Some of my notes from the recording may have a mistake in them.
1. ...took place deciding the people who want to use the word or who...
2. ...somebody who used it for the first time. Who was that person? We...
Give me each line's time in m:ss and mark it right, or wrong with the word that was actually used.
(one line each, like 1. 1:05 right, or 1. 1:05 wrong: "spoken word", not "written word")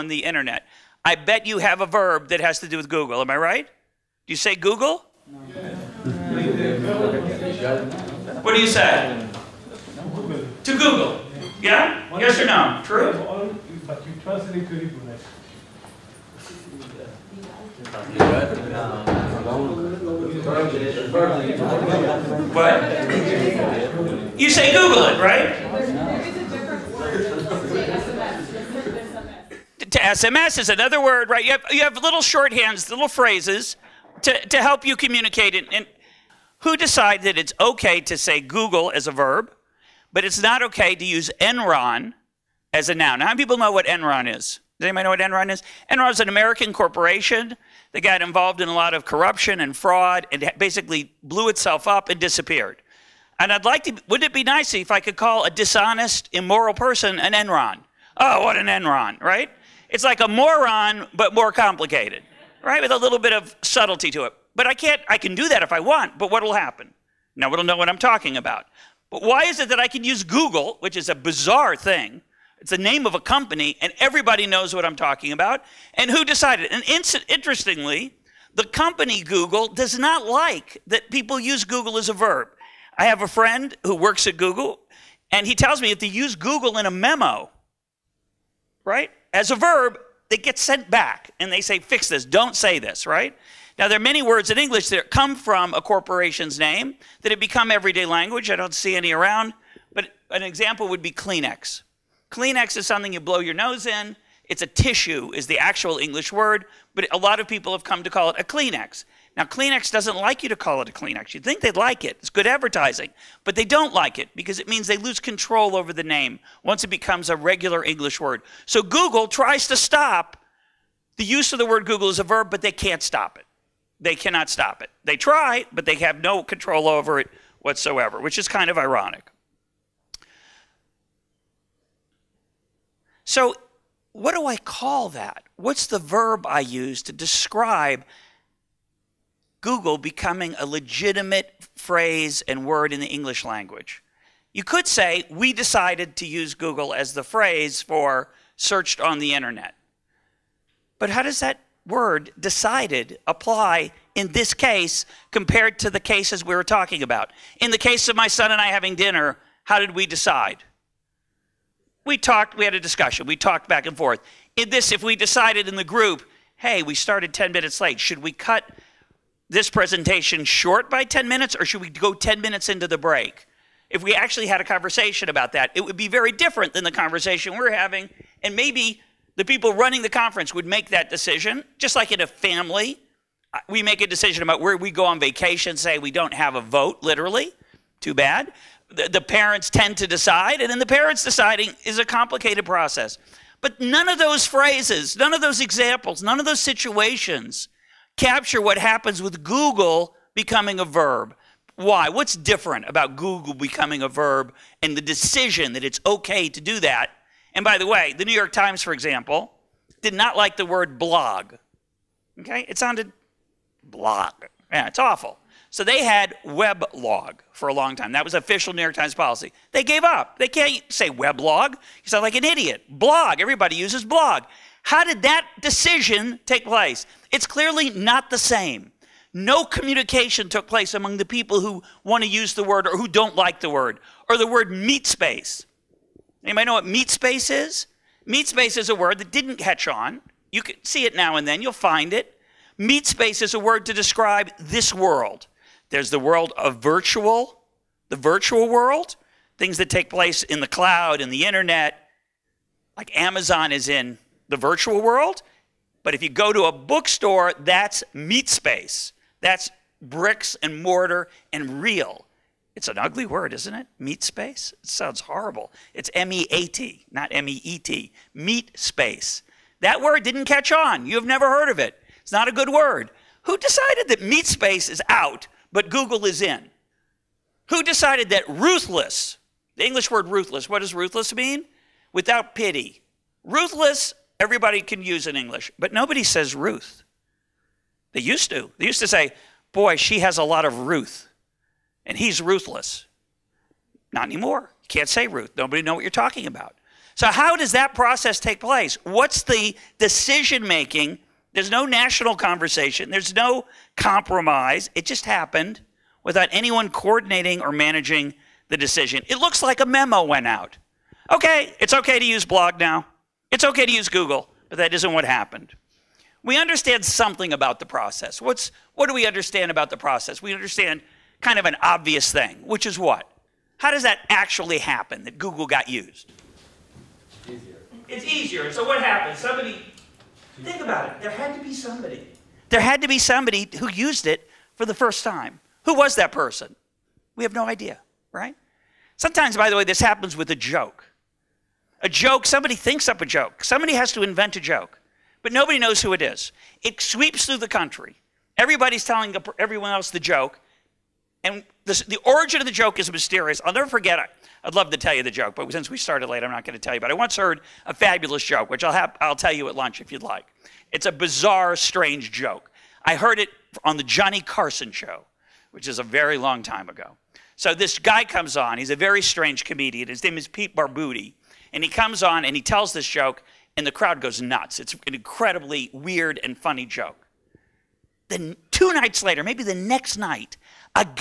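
1. 3:50 wrong: "among", not "deciding"
2. 5:33 right.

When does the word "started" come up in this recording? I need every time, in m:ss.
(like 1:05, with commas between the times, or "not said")
2:46, 5:55.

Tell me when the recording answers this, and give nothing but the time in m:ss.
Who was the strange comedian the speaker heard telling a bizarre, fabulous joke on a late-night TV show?
6:10.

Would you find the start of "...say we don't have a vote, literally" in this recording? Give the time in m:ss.
3:05.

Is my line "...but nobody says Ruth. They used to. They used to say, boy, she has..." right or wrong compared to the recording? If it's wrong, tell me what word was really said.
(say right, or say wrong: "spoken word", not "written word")
right.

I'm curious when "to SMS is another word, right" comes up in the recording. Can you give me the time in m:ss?
0:29.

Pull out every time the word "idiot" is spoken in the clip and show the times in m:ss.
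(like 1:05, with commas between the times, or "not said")
3:42.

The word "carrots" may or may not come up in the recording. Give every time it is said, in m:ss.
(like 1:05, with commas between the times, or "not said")
not said.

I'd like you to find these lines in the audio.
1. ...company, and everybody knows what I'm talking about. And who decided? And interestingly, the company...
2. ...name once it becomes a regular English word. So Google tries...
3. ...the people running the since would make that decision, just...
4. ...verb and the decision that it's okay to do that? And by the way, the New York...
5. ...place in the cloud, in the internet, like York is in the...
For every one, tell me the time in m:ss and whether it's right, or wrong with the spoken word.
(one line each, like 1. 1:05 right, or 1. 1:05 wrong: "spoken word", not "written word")
1. 1:13 right
2. 1:56 right
3. 2:59 wrong: "conference", not "since"
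4. 3:24 right
5. 4:10 wrong: "Amazon", not "York".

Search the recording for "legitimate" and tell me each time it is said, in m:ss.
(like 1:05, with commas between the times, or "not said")
2:20.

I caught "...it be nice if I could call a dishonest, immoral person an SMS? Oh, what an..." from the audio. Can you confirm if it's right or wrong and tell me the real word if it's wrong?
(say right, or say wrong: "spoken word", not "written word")
wrong: "Enron", not "SMS".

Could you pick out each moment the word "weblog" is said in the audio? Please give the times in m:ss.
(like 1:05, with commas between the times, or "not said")
3:36, 3:41.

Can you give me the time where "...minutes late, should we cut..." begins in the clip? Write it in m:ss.
2:47.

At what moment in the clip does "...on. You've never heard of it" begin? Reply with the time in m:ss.
4:30.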